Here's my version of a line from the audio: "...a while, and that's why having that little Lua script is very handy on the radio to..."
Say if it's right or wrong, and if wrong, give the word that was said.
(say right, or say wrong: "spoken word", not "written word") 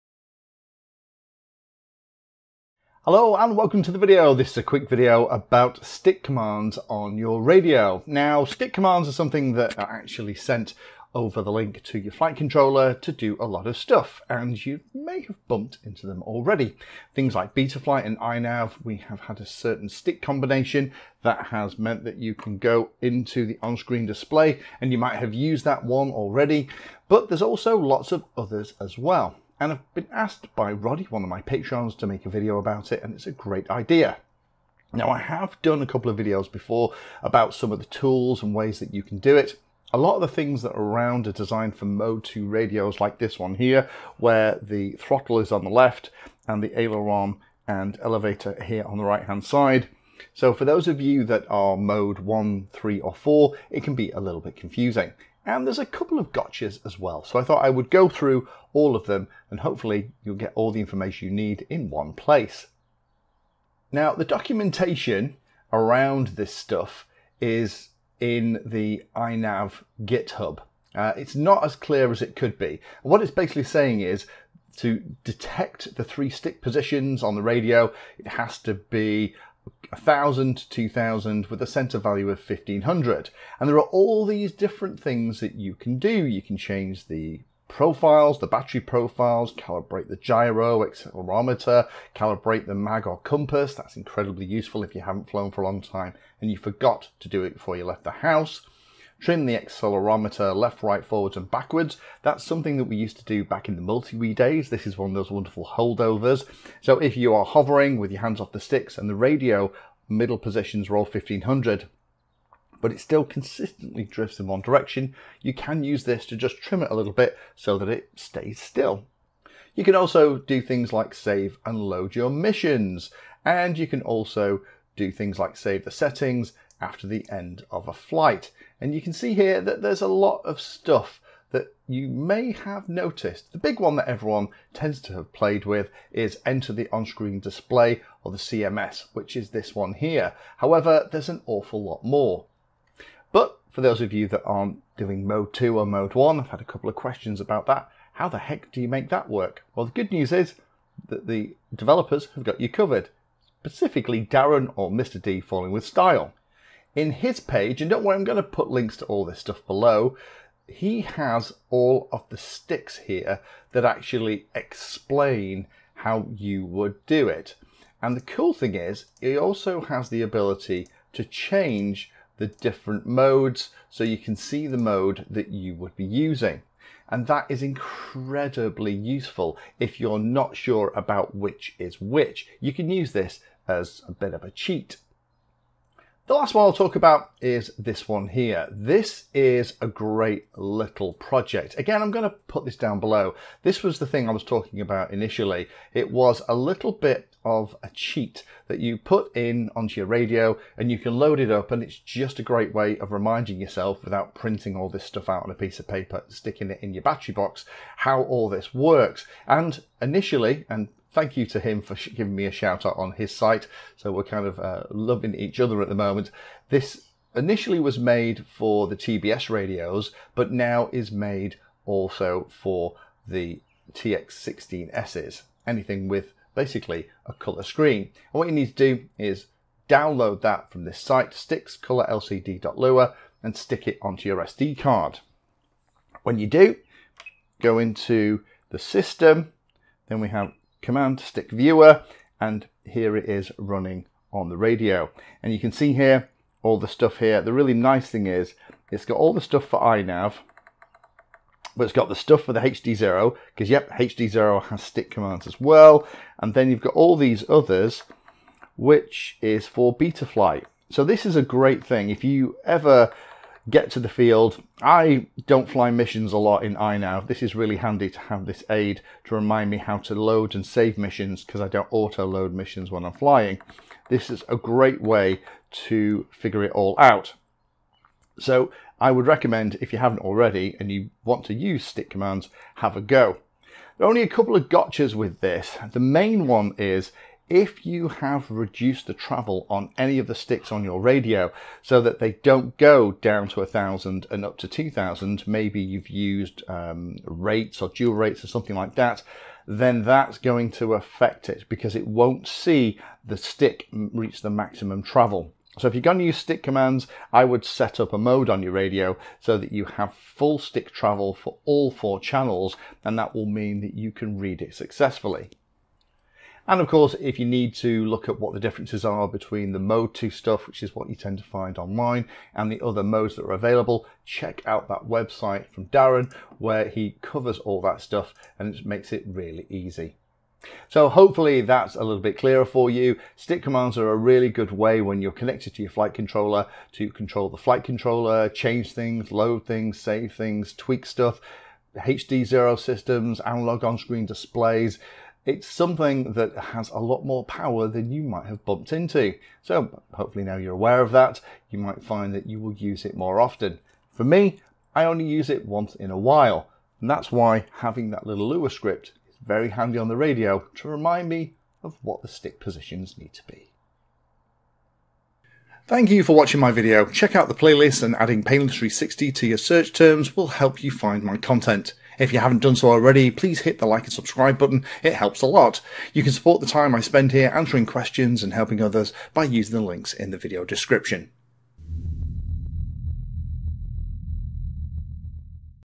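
right.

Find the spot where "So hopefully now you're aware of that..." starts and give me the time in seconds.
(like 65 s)
349 s.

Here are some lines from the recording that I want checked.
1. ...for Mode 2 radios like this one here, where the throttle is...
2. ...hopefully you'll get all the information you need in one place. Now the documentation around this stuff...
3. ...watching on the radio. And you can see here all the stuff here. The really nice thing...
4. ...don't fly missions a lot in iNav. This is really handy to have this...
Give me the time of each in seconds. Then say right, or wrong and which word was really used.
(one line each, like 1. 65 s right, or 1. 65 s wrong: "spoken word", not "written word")
1. 41 s right
2. 59 s right
3. 243 s wrong: "running", not "watching"
4. 265 s right.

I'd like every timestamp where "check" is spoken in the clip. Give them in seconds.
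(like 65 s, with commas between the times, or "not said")
324 s, 367 s.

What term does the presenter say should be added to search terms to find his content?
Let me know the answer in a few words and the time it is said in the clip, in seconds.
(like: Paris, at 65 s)
painless 360, at 368 s.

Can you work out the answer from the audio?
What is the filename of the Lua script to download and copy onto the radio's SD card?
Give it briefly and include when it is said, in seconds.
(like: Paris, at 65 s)
stickscolorlcd.lua, at 231 s.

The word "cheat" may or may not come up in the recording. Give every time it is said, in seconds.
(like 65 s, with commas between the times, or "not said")
184 s, 197 s.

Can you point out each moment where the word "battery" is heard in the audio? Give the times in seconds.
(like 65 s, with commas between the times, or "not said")
88 s, 207 s.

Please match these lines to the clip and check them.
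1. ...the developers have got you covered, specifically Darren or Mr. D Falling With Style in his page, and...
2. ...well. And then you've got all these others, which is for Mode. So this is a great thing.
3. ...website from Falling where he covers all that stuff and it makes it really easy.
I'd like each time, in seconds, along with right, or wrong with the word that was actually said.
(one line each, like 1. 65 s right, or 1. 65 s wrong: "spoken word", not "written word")
1. 151 s right
2. 255 s wrong: "Betaflight", not "Mode"
3. 325 s wrong: "Darren", not "Falling".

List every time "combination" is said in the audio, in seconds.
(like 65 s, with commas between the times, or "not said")
20 s.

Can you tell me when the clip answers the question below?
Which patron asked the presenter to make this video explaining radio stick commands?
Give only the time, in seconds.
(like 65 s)
30 s.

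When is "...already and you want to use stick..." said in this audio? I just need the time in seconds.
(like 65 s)
280 s.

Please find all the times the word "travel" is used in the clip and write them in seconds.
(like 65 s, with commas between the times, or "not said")
289 s, 305 s, 310 s.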